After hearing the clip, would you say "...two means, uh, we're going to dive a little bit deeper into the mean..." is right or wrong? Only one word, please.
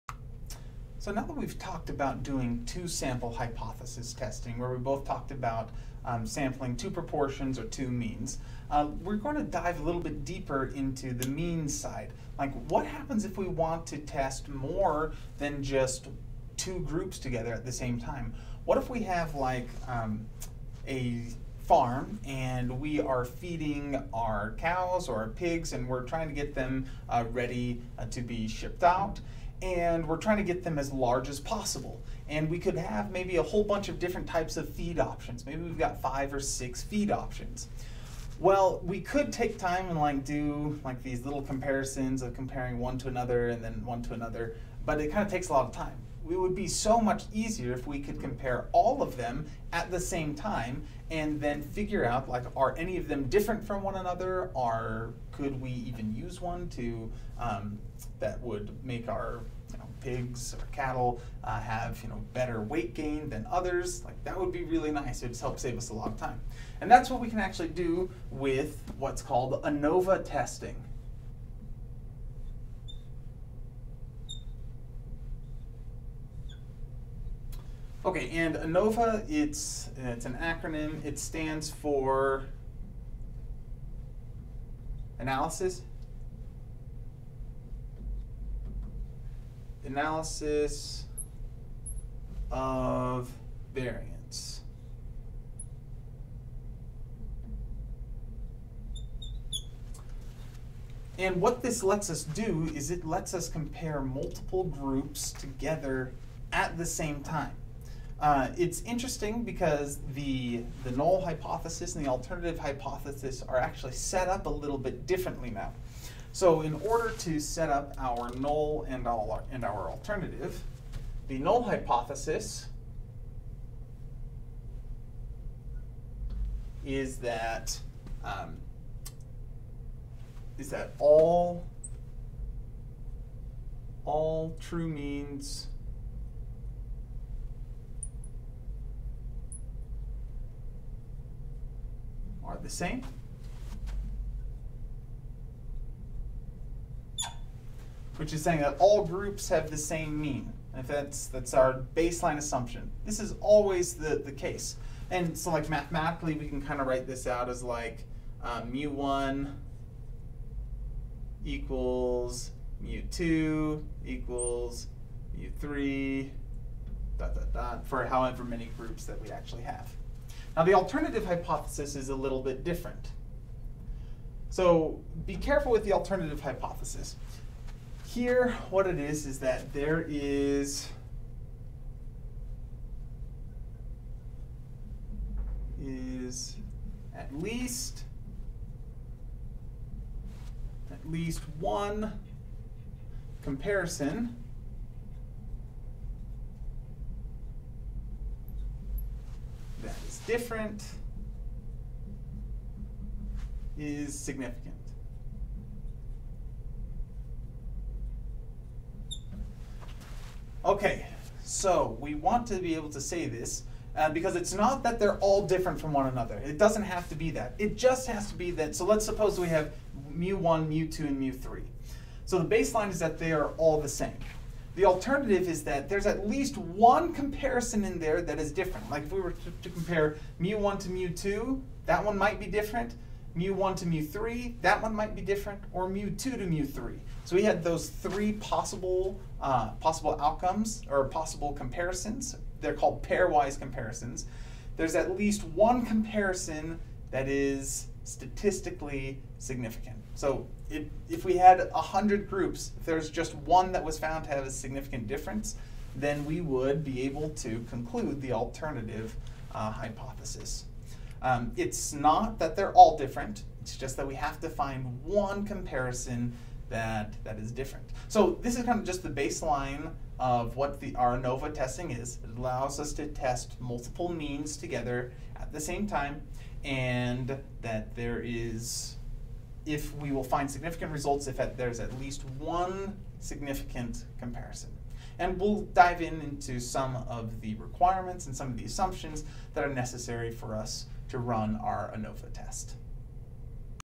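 right.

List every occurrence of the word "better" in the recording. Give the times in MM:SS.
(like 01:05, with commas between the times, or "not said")
01:02.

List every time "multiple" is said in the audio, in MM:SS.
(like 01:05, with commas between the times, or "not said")
01:44, 04:33.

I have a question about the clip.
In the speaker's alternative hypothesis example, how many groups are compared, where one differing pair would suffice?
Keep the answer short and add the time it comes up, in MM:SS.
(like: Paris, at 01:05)
100, at 04:11.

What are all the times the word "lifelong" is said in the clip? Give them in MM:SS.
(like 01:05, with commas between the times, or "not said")
not said.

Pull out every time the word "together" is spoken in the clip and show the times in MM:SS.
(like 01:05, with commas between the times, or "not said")
00:17, 01:45, 04:34.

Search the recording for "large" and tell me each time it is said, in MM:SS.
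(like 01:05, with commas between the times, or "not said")
00:30.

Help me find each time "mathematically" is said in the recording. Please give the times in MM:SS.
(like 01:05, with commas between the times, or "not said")
02:35.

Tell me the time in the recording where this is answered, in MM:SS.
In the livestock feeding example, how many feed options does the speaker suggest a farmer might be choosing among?
00:36.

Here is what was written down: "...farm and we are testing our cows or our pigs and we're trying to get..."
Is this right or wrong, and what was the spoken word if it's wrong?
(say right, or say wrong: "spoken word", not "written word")
wrong: "feeding", not "testing".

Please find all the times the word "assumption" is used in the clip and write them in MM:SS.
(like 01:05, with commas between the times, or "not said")
02:32, 04:48.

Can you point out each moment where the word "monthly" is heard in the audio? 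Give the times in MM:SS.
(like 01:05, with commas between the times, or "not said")
not said.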